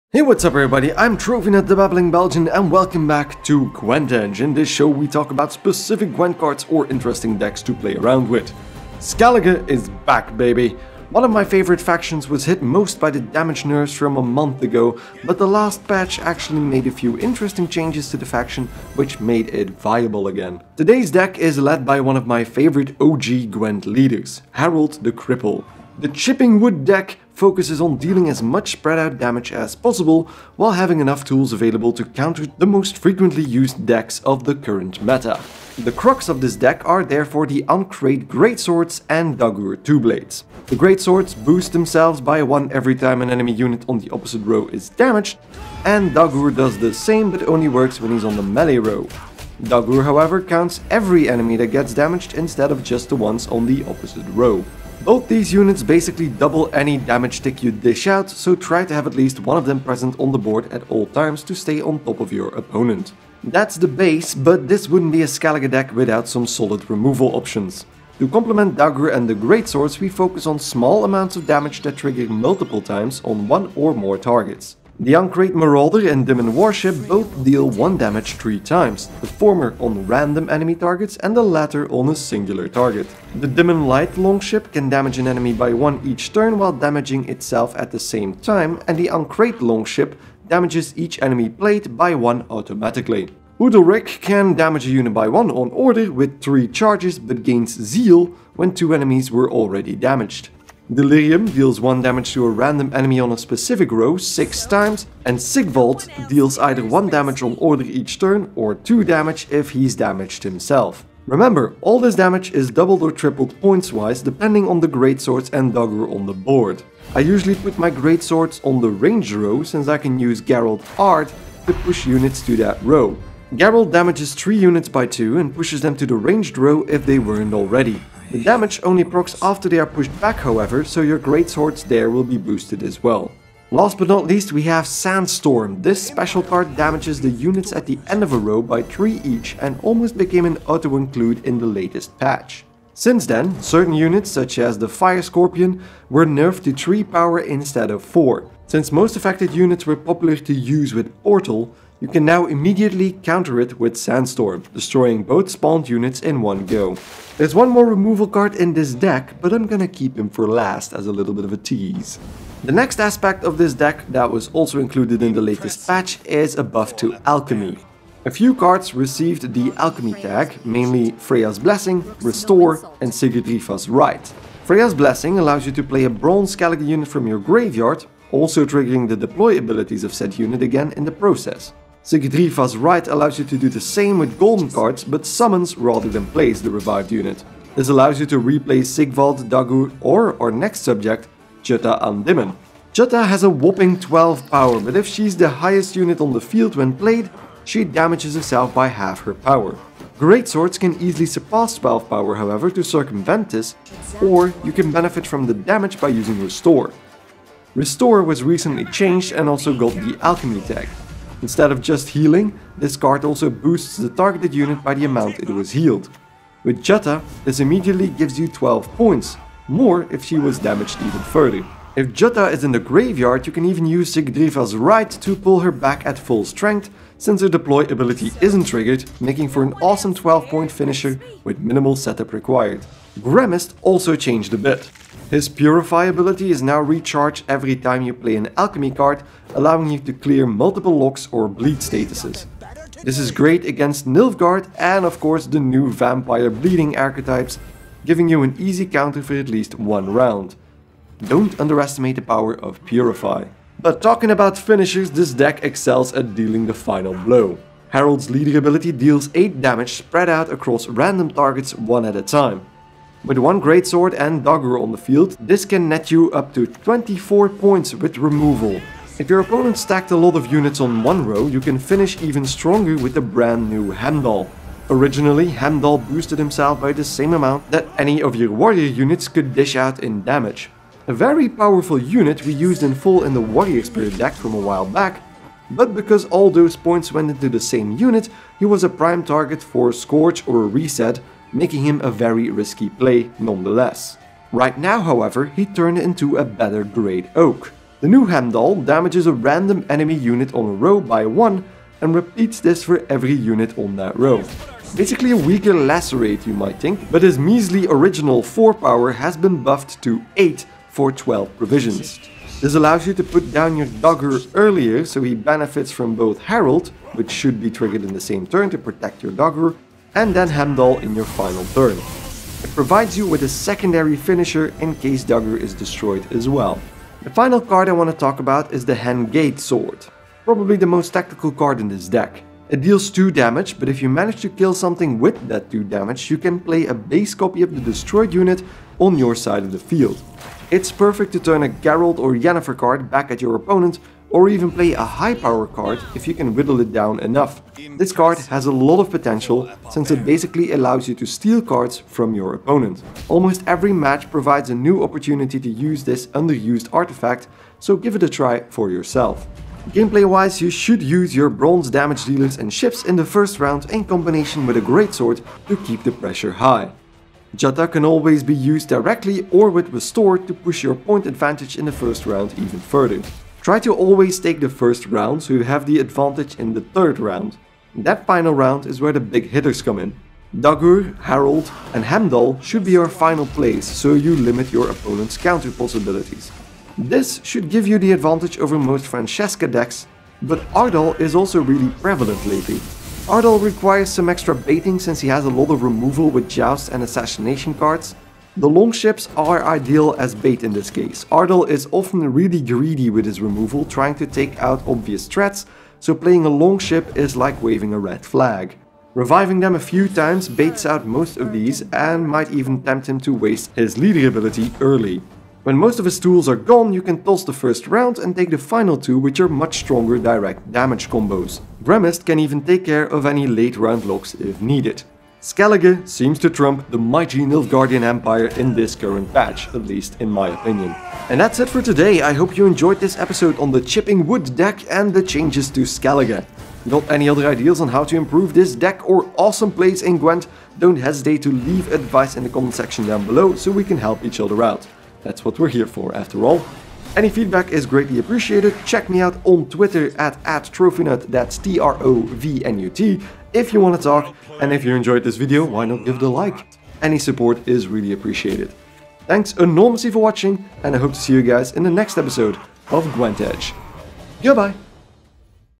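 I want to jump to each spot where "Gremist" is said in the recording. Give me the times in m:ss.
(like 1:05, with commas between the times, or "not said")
3:53, 7:01.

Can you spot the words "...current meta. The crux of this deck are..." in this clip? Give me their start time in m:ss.
0:34.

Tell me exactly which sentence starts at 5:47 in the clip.
This card has a lot of potential since it basically allows you to steal cards from your opponent.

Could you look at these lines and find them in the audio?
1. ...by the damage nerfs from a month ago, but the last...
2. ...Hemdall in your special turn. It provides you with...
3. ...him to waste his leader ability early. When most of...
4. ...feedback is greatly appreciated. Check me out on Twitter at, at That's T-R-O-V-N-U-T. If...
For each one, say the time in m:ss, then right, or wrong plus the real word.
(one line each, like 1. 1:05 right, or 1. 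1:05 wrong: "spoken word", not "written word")
1. 0:12 right
2. 5:20 wrong: "final", not "special"
3. 6:53 right
4. 7:27 right.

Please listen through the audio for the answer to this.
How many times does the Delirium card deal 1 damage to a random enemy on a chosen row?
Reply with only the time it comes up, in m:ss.
1:44.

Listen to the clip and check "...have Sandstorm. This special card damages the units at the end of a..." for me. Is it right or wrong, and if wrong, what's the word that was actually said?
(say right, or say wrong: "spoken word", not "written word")
right.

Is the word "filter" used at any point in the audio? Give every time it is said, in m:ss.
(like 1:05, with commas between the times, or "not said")
not said.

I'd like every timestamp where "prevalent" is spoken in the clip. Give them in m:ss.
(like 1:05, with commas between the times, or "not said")
6:32.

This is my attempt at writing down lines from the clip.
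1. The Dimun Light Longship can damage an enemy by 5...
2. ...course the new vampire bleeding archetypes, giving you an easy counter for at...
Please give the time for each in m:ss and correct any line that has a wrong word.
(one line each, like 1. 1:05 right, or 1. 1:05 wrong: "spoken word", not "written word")
1. 1:23 wrong: "1", not "5"
2. 4:05 right.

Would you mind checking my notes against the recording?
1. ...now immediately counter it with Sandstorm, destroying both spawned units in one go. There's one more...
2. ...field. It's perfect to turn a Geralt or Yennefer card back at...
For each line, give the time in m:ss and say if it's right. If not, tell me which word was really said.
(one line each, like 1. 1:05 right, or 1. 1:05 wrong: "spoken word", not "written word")
1. 2:32 right
2. 5:39 right.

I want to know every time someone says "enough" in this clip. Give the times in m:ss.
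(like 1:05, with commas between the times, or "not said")
0:30, 5:47.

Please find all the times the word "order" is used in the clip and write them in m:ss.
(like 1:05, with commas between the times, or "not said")
1:35, 1:47.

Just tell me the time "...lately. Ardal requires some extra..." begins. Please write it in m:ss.
6:32.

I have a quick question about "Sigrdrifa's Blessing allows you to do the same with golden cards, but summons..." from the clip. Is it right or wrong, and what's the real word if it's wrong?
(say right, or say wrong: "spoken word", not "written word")
wrong: "Rite", not "Blessing".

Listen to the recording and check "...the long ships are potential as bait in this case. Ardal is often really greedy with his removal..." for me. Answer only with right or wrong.
wrong.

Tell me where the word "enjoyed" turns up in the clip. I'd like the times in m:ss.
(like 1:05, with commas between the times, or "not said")
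7:12, 7:34.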